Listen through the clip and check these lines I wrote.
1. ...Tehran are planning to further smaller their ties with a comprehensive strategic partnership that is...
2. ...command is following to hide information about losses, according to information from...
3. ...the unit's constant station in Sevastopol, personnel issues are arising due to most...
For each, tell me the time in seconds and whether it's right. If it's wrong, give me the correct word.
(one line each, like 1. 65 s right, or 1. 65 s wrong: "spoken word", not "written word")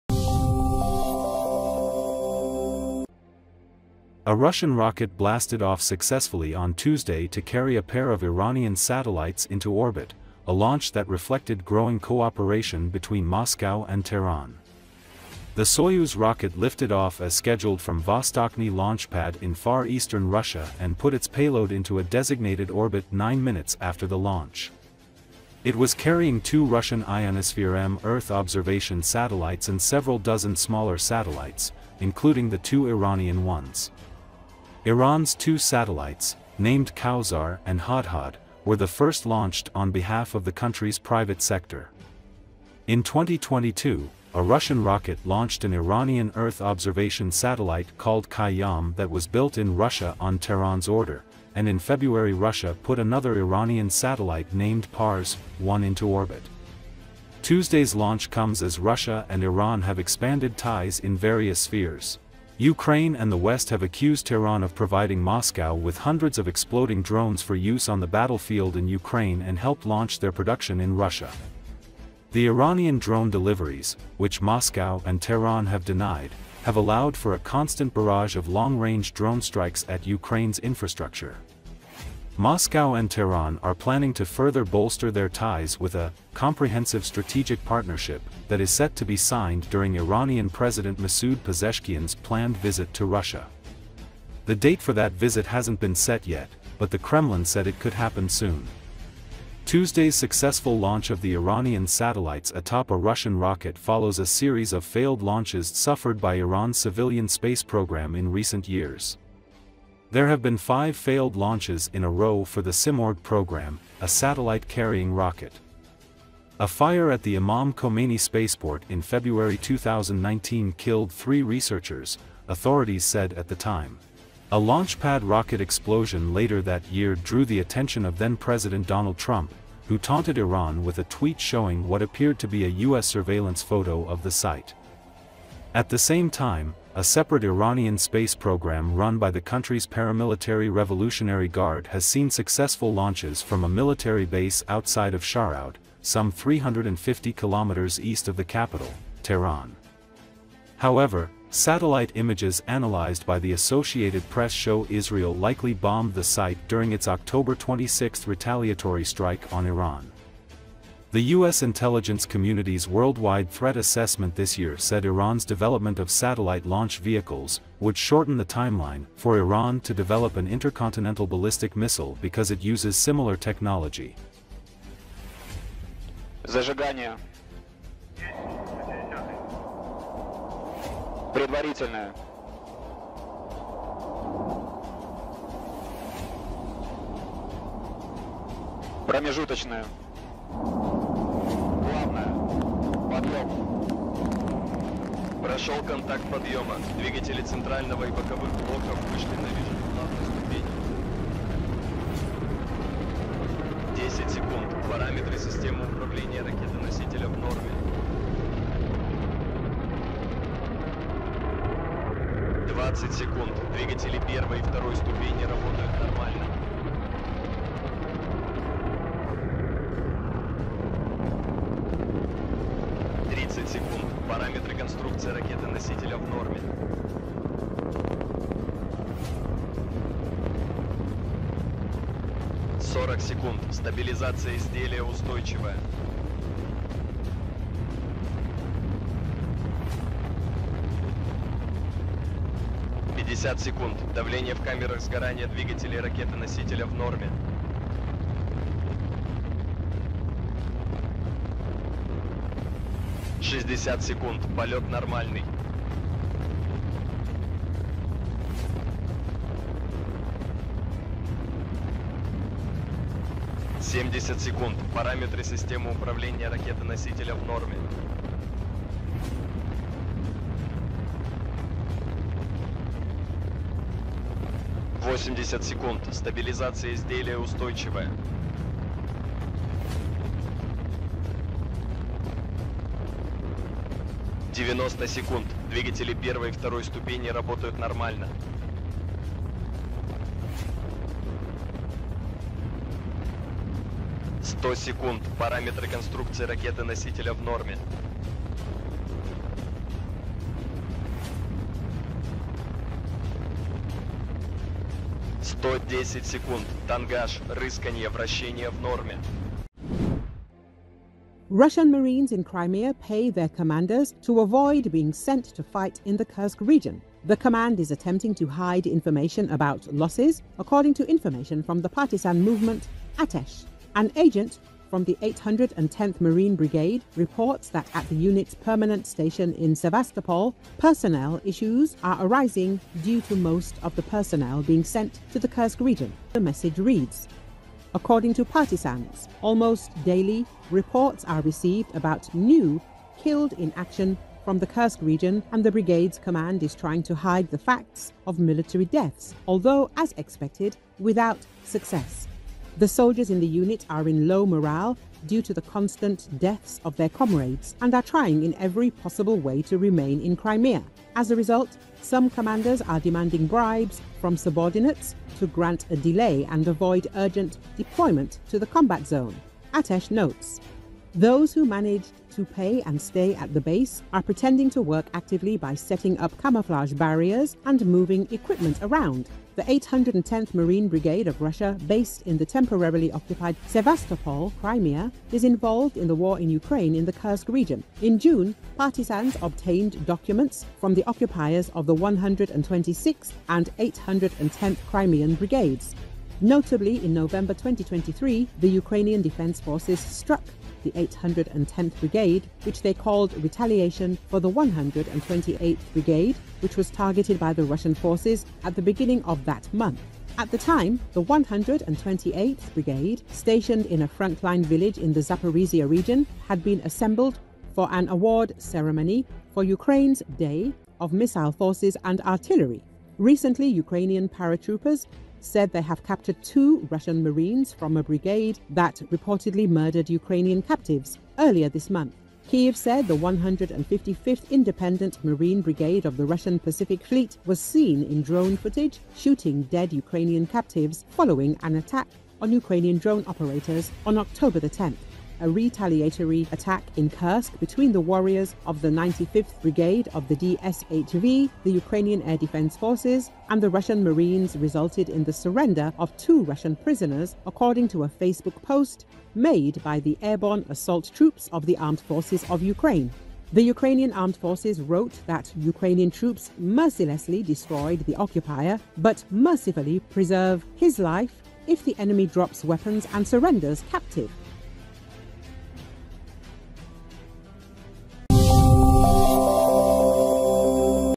1. 83 s wrong: "bolster", not "smaller"
2. 317 s wrong: "attempting", not "following"
3. 328 s wrong: "permanent", not "constant".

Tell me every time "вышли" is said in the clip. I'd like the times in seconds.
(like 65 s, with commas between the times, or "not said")
199 s.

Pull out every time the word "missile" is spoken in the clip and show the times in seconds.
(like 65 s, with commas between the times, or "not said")
171 s, 421 s.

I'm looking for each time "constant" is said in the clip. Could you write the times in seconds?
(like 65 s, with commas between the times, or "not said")
77 s, 355 s.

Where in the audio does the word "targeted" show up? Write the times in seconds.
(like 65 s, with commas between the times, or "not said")
406 s.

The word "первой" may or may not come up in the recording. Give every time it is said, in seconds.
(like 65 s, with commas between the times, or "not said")
214 s, 286 s.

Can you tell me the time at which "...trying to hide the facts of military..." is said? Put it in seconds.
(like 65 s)
346 s.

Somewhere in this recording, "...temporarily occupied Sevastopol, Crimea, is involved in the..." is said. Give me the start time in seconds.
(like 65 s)
382 s.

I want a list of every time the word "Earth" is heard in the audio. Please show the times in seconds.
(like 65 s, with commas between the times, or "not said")
28 s, 46 s.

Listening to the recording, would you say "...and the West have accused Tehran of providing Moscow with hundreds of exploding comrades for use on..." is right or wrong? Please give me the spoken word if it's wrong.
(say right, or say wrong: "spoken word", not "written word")
wrong: "drones", not "comrades".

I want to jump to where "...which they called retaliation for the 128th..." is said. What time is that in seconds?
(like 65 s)
402 s.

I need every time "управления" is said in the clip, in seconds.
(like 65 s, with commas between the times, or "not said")
205 s, 265 s.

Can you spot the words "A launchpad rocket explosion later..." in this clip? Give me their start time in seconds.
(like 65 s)
124 s.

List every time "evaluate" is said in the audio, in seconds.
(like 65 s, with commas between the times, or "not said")
not said.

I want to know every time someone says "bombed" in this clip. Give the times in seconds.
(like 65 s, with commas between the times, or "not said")
155 s.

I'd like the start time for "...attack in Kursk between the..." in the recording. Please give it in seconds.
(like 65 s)
446 s.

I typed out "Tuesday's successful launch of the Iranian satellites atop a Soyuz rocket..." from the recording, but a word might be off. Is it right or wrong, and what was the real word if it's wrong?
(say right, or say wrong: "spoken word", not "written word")
wrong: "Russian", not "Soyuz".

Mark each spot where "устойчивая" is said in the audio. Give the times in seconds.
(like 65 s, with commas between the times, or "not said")
235 s, 277 s.